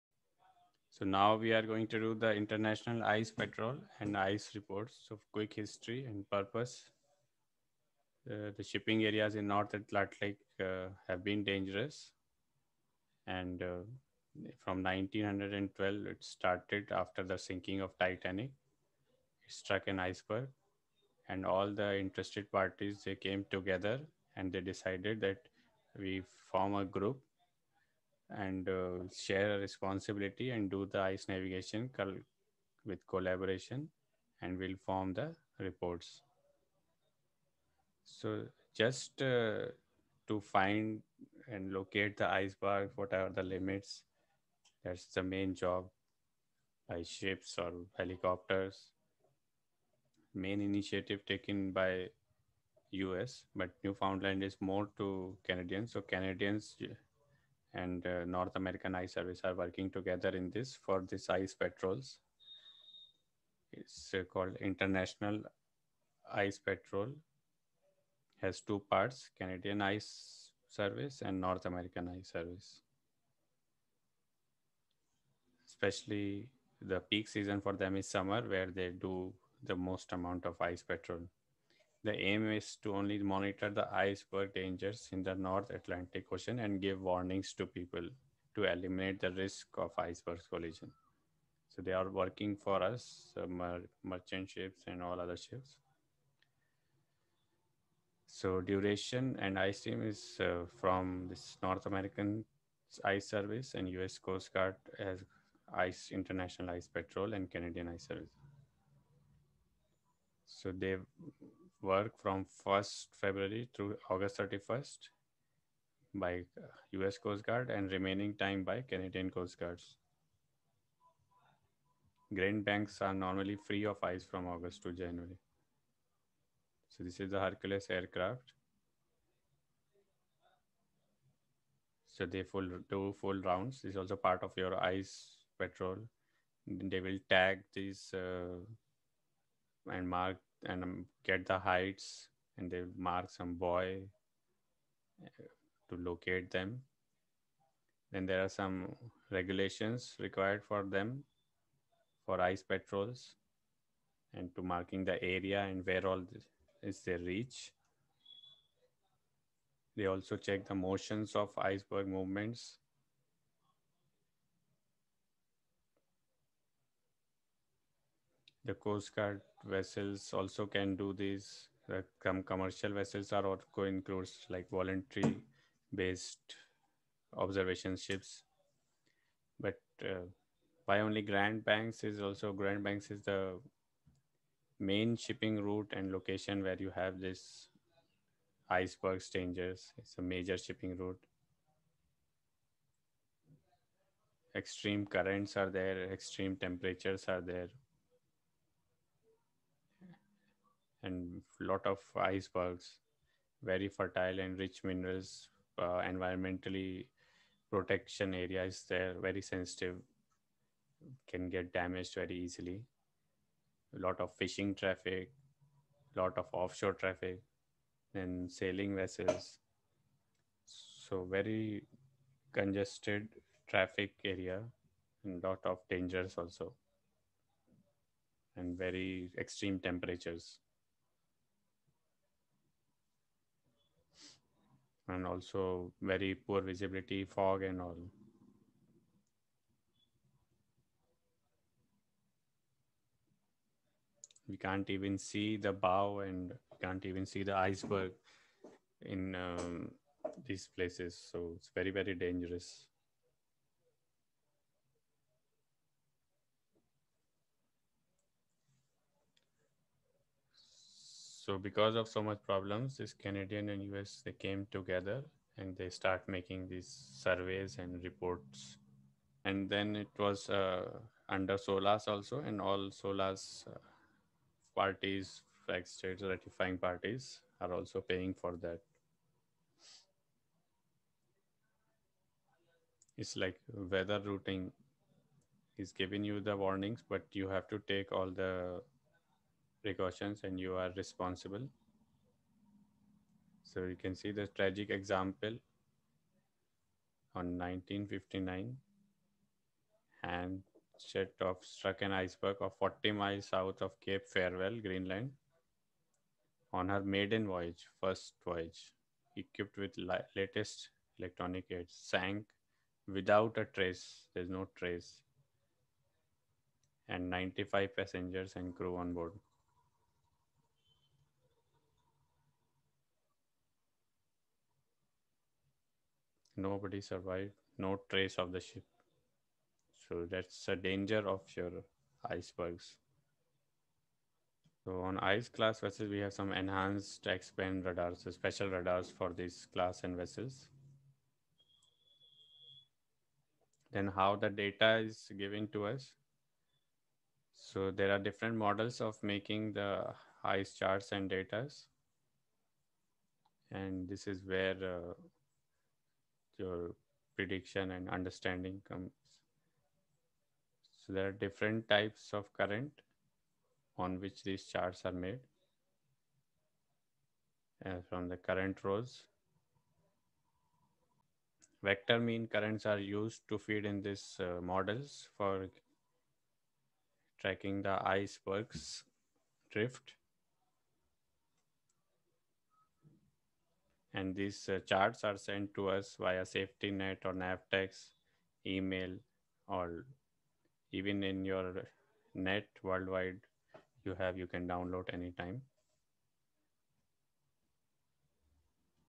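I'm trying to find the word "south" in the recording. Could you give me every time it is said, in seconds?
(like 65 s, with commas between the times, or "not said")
303 s.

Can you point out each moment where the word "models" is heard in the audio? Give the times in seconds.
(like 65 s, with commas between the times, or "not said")
348 s, 374 s.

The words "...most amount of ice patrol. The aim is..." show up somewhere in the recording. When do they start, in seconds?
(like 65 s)
79 s.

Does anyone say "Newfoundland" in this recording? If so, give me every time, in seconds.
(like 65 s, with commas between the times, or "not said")
53 s.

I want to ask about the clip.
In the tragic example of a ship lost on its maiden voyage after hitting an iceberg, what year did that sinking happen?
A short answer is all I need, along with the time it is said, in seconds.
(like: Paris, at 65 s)
1959, at 297 s.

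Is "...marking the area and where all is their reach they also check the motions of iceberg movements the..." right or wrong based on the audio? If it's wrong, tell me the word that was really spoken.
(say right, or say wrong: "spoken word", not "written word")
right.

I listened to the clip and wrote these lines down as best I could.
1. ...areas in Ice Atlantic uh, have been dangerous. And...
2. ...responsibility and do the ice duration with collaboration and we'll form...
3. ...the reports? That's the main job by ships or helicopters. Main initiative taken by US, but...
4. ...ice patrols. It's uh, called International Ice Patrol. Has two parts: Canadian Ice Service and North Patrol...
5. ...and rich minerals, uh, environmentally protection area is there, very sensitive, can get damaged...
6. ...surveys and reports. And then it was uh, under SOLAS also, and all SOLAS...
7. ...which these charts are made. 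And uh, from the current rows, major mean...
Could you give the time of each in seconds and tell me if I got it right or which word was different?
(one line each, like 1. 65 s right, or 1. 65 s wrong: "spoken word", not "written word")
1. 9 s wrong: "North", not "Ice"
2. 29 s wrong: "navigation", not "duration"
3. 43 s wrong: "limits", not "reports"
4. 61 s wrong: "American", not "Patrol"
5. 204 s right
6. 267 s right
7. 364 s wrong: "vector", not "major".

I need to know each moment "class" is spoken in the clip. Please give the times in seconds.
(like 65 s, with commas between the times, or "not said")
335 s, 339 s.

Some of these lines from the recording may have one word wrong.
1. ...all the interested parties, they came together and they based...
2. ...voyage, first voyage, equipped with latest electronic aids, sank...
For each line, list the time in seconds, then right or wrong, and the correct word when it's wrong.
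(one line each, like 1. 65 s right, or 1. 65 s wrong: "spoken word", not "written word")
1. 21 s wrong: "decided", not "based"
2. 307 s right.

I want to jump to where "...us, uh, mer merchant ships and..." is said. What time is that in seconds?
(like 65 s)
92 s.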